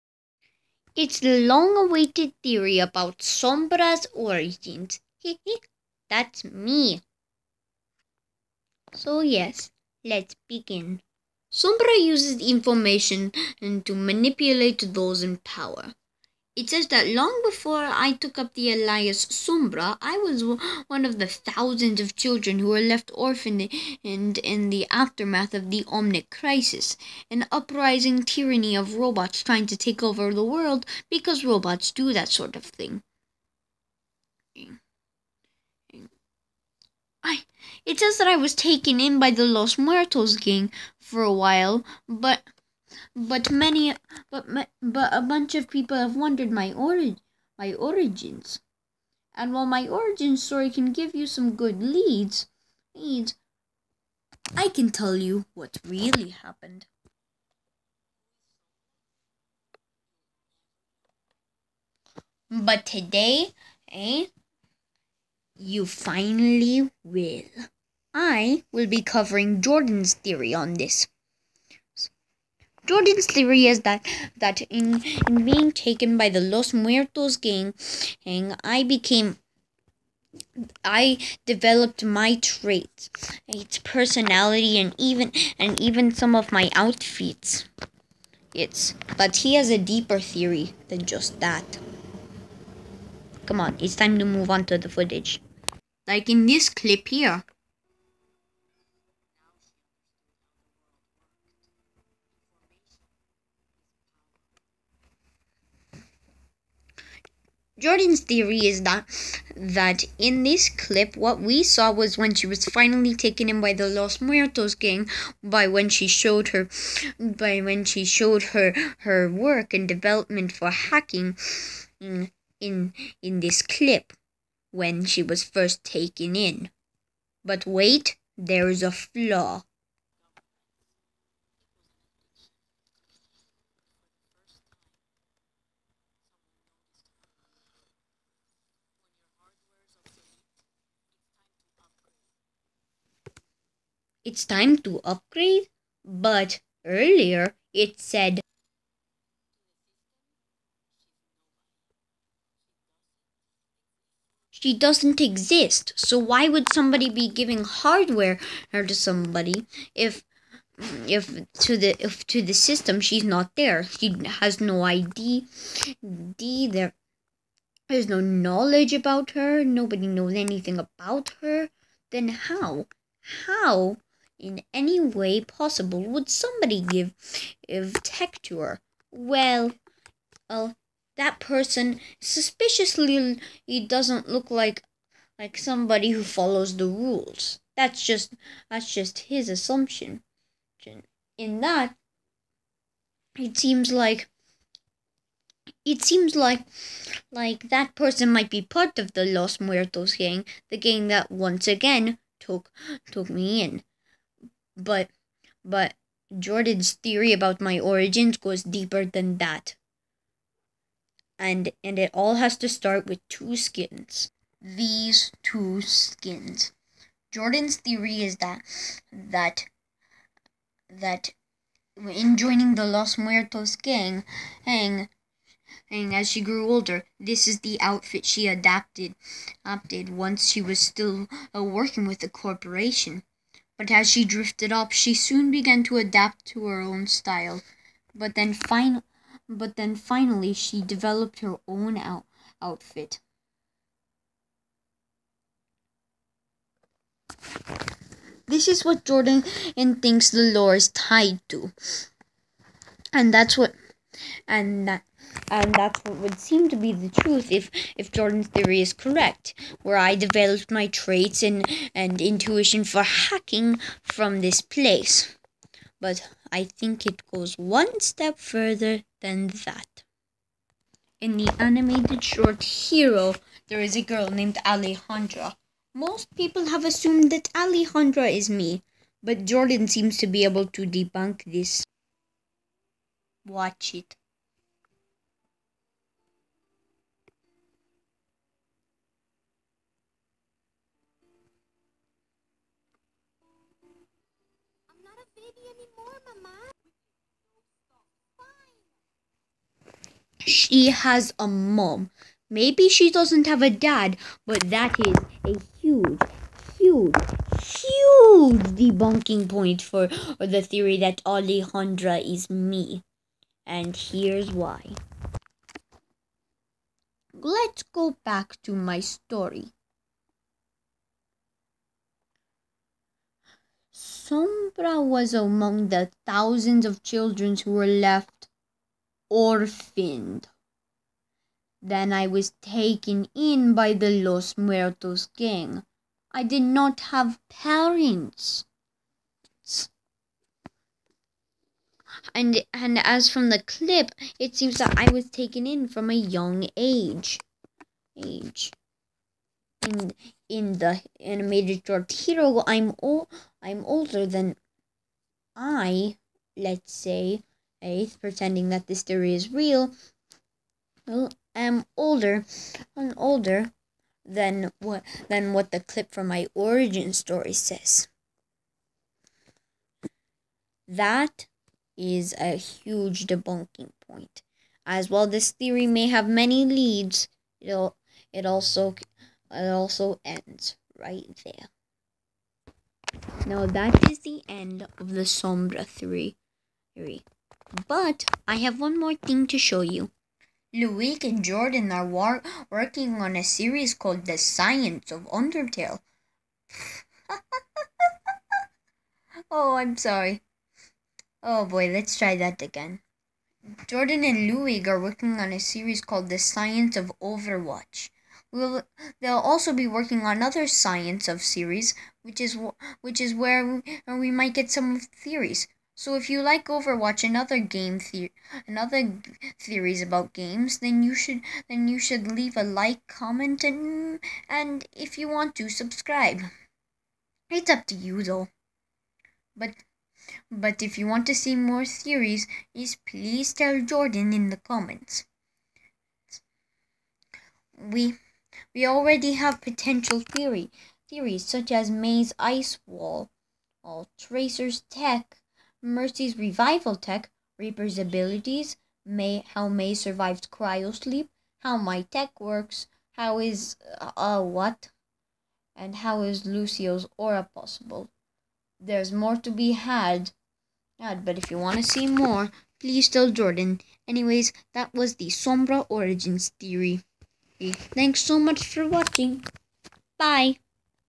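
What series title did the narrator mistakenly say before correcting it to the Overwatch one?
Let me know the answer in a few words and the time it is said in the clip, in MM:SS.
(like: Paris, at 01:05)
The Science of Undertale, at 06:34.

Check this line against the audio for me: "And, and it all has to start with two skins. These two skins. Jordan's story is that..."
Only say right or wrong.
wrong.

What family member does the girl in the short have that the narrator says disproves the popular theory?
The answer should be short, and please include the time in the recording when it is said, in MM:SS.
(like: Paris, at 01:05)
A mom, at 05:01.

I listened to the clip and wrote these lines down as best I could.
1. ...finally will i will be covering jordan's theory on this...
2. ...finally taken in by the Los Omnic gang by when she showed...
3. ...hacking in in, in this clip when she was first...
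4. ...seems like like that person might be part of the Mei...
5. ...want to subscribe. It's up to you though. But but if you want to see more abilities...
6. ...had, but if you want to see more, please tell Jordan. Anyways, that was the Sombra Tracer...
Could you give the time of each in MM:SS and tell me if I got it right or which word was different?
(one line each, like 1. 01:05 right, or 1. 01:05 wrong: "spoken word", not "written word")
1. 01:05 right
2. 01:52 wrong: "Muertos", not "Omnic"
3. 02:00 right
4. 03:16 wrong: "Los", not "Mei"
5. 07:05 wrong: "theories", not "abilities"
6. 07:39 wrong: "Origins", not "Tracer".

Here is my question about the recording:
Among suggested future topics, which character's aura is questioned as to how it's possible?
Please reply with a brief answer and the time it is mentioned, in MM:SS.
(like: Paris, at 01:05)
Lucio, at 07:36.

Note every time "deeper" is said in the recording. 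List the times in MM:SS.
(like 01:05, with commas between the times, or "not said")
01:29, 03:28.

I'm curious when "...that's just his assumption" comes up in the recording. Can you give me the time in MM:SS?
03:08.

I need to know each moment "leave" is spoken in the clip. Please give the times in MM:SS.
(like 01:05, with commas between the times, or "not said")
07:02.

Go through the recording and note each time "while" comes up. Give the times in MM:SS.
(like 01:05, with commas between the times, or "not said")
00:41, 00:49.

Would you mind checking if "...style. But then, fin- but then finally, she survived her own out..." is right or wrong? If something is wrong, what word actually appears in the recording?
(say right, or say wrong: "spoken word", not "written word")
wrong: "developed", not "survived".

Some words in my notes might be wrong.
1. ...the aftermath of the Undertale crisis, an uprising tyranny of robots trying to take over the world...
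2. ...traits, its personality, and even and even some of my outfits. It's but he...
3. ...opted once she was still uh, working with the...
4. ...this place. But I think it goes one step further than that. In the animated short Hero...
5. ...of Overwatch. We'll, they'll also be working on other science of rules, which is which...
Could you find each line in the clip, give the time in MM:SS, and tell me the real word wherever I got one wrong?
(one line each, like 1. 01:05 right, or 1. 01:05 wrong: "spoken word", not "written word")
1. 00:24 wrong: "Omnic", not "Undertale"
2. 01:22 right
3. 03:49 right
4. 04:24 right
5. 06:46 wrong: "series", not "rules".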